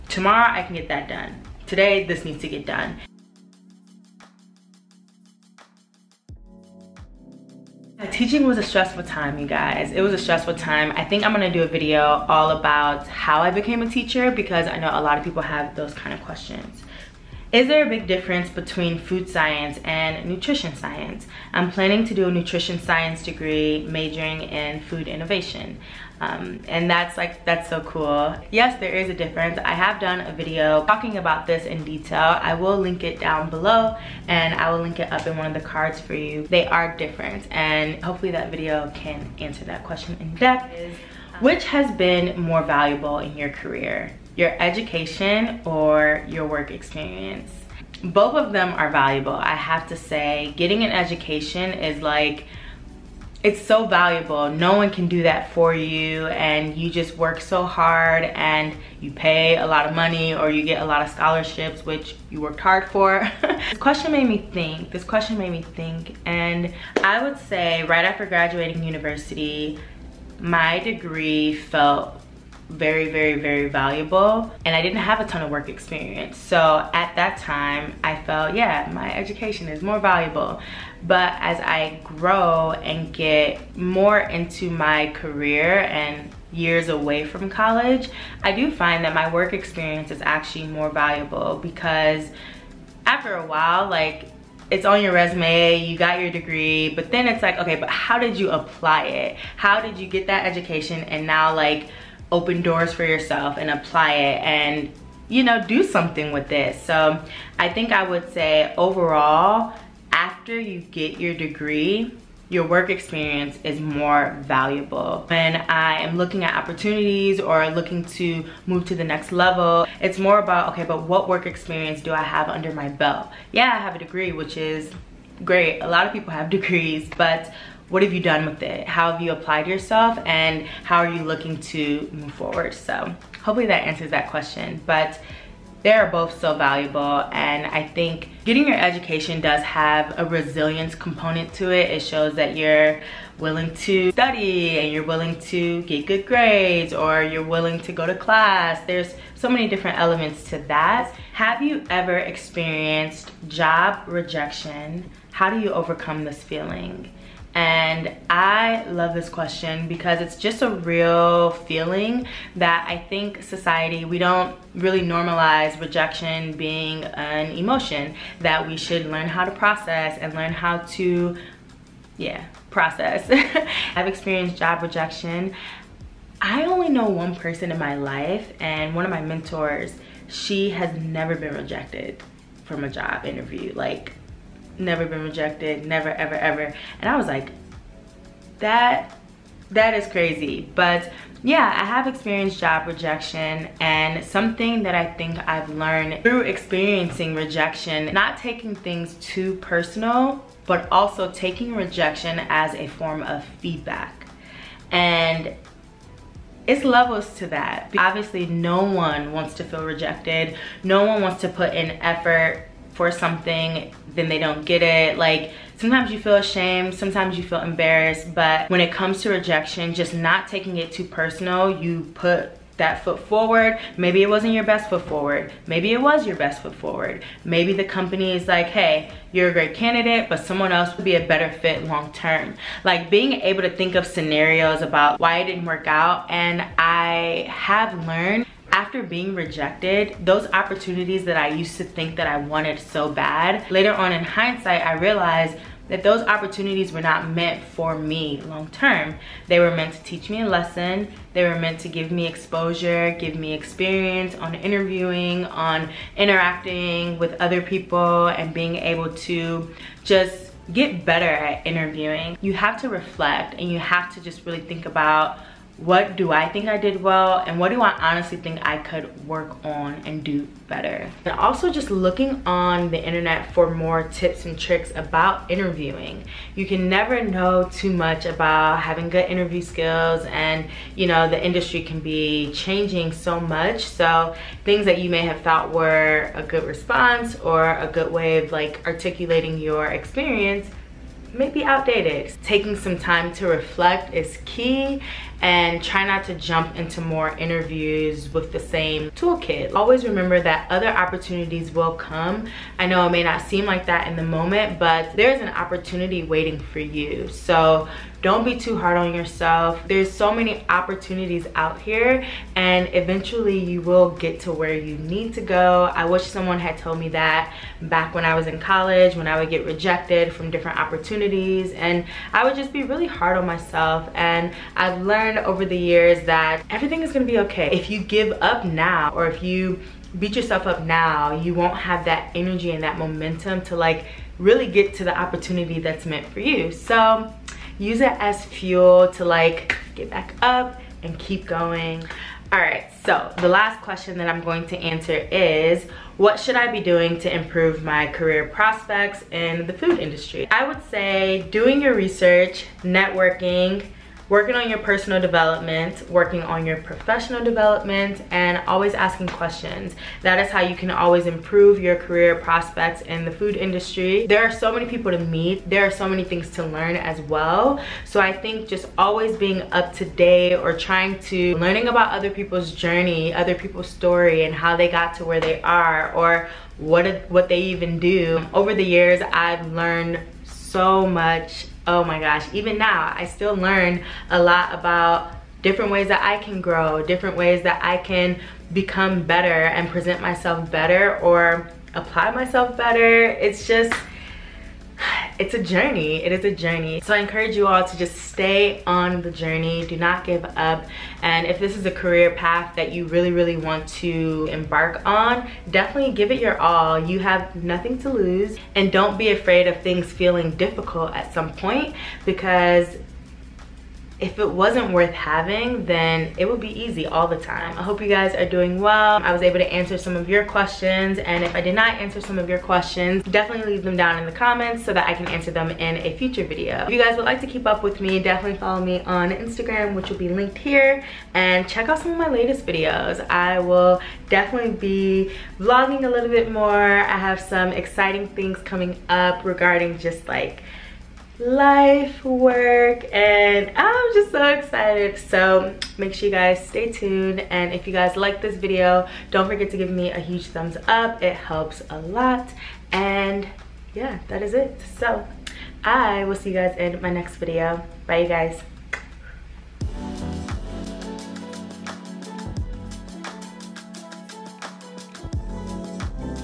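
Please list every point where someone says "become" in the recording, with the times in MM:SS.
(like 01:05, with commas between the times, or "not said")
06:28.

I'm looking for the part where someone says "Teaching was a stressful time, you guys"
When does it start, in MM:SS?
00:08.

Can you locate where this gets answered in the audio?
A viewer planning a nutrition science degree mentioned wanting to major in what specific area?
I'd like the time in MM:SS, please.
00:24.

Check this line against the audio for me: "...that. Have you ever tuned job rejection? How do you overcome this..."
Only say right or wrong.
wrong.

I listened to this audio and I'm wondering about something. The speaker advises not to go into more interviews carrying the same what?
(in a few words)
toolkit.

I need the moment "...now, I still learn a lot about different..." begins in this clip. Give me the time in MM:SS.
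06:22.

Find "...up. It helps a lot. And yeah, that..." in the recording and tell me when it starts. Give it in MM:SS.
07:30.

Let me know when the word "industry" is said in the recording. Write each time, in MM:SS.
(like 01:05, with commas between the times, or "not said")
04:41, 05:49, 06:03.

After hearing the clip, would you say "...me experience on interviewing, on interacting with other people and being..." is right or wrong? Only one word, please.
right.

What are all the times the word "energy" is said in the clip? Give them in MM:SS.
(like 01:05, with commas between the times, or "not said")
05:32.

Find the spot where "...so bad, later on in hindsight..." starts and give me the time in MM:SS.
04:02.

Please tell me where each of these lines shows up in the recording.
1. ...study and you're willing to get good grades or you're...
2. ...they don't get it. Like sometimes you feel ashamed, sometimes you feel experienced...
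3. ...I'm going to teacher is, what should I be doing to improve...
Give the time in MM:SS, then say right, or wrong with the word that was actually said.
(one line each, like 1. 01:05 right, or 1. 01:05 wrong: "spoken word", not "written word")
1. 02:24 right
2. 03:34 wrong: "embarrassed", not "experienced"
3. 05:44 wrong: "answer", not "teacher".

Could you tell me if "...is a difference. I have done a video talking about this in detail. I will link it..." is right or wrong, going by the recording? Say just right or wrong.
right.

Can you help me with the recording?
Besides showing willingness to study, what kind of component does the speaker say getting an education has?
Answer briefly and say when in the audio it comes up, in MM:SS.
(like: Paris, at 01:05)
a resilience component, at 02:20.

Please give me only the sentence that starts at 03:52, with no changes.
Like being able to think of scenarios about why it didn't work out.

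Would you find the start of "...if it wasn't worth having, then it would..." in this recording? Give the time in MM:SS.
06:54.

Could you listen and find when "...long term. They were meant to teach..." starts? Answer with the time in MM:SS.
04:08.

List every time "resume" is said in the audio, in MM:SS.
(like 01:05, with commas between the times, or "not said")
01:35.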